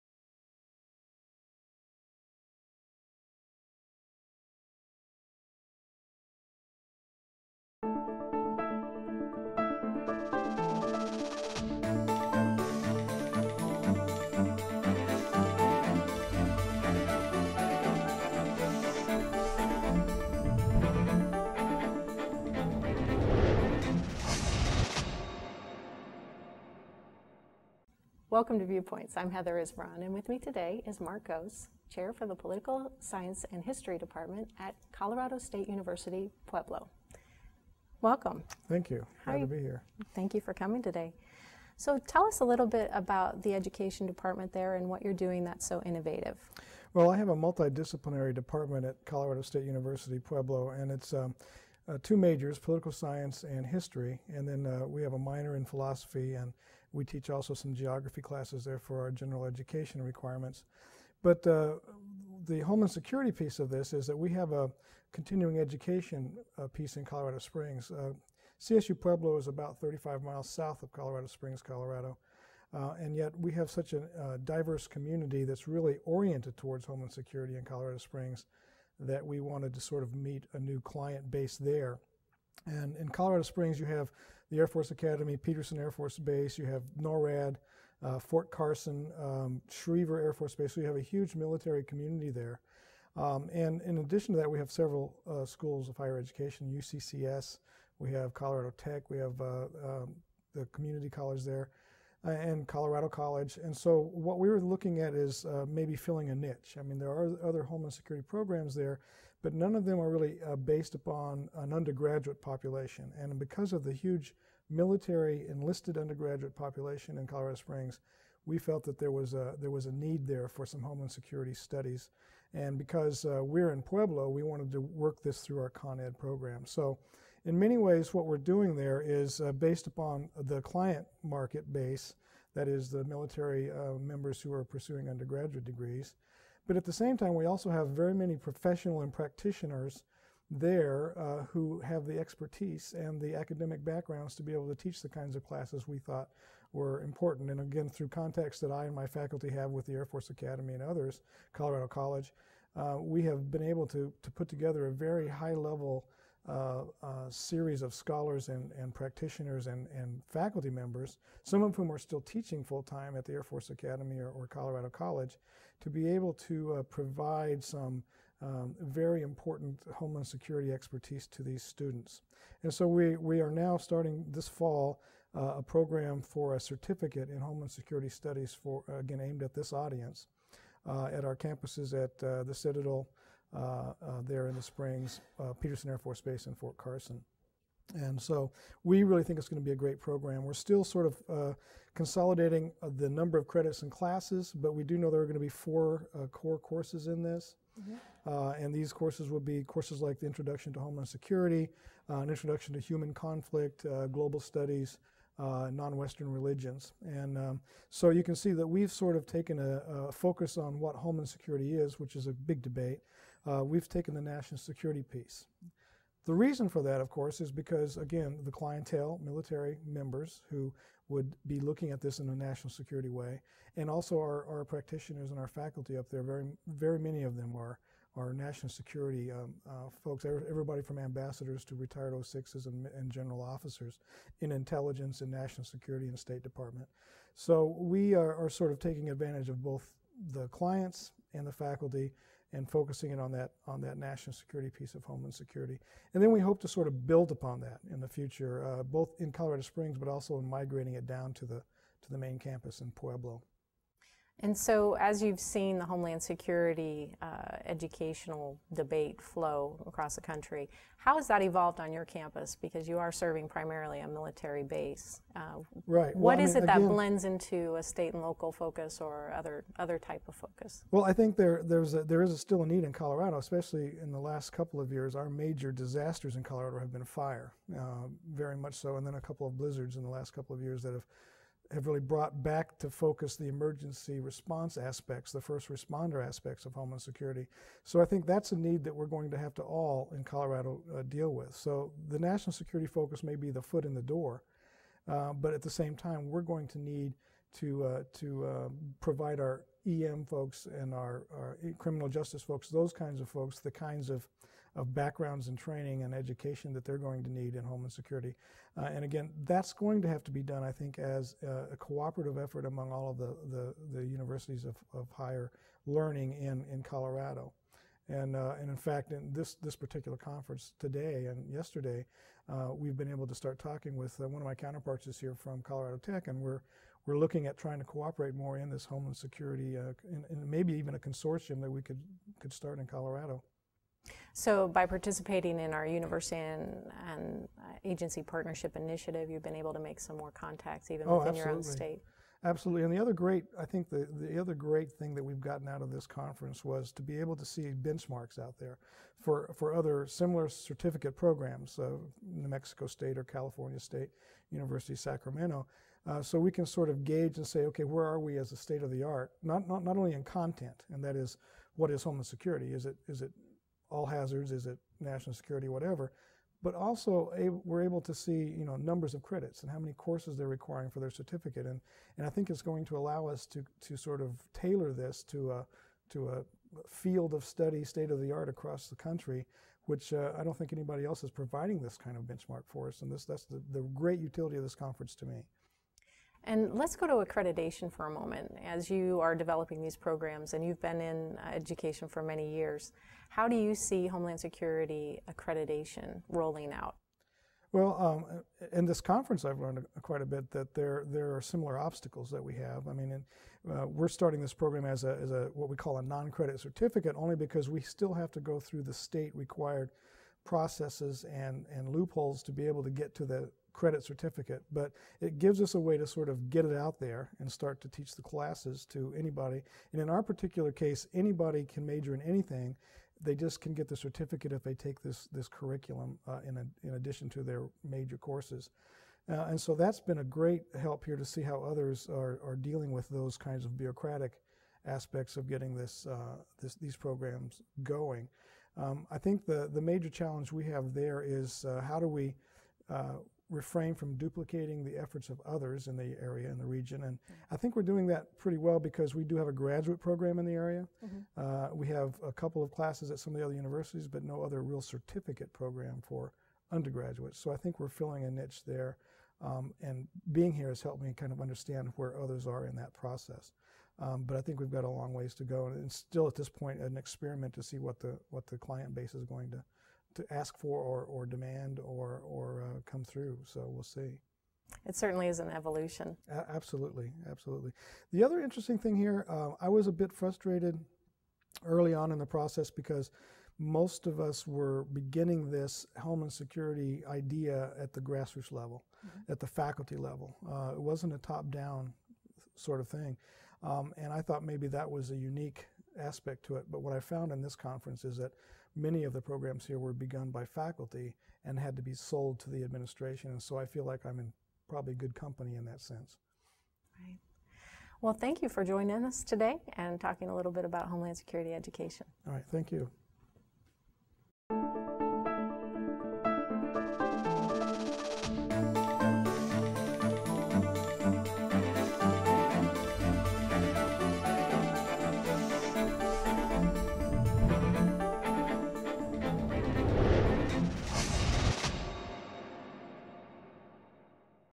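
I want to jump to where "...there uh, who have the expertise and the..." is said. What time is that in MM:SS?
02:20.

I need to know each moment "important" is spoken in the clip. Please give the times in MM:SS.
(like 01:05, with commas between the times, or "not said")
02:27, 02:49.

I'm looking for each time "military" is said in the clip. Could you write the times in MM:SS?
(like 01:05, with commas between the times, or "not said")
01:31, 01:54, 02:13, 03:39, 04:24.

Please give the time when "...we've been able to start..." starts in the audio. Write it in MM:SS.
05:22.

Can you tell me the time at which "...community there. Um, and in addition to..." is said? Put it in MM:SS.
01:31.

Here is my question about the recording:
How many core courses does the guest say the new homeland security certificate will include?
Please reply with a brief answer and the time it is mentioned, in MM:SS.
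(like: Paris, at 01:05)
4, at 03:15.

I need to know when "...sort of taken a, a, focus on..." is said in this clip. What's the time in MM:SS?
03:28.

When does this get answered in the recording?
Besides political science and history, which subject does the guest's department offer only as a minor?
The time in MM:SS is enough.
00:55.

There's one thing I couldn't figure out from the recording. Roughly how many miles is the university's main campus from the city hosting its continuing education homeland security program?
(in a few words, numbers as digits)
35.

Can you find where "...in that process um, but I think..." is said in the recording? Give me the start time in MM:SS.
07:42.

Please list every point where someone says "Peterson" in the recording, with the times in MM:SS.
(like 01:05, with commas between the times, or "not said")
01:25, 03:05.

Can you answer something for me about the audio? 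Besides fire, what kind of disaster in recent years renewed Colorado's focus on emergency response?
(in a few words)
Blizzards.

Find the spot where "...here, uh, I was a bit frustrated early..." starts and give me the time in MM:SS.
07:58.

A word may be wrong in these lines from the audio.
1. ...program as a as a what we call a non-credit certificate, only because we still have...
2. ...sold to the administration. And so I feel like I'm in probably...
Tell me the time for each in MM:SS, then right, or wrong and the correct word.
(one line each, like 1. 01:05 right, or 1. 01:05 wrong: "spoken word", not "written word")
1. 06:44 right
2. 08:21 right.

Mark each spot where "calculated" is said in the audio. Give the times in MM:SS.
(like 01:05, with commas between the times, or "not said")
not said.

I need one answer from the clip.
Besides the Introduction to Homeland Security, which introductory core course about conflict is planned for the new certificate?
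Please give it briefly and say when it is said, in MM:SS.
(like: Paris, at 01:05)
Introduction to Human Conflict, at 03:22.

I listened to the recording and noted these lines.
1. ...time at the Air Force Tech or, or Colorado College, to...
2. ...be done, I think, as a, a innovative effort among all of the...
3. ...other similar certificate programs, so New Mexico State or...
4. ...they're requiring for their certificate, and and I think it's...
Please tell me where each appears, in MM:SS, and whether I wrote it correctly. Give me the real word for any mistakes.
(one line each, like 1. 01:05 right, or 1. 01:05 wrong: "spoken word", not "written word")
1. 02:42 wrong: "Academy", not "Tech"
2. 05:10 wrong: "cooperative", not "innovative"
3. 05:49 right
4. 06:10 right.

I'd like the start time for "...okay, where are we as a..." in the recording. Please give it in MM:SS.
05:57.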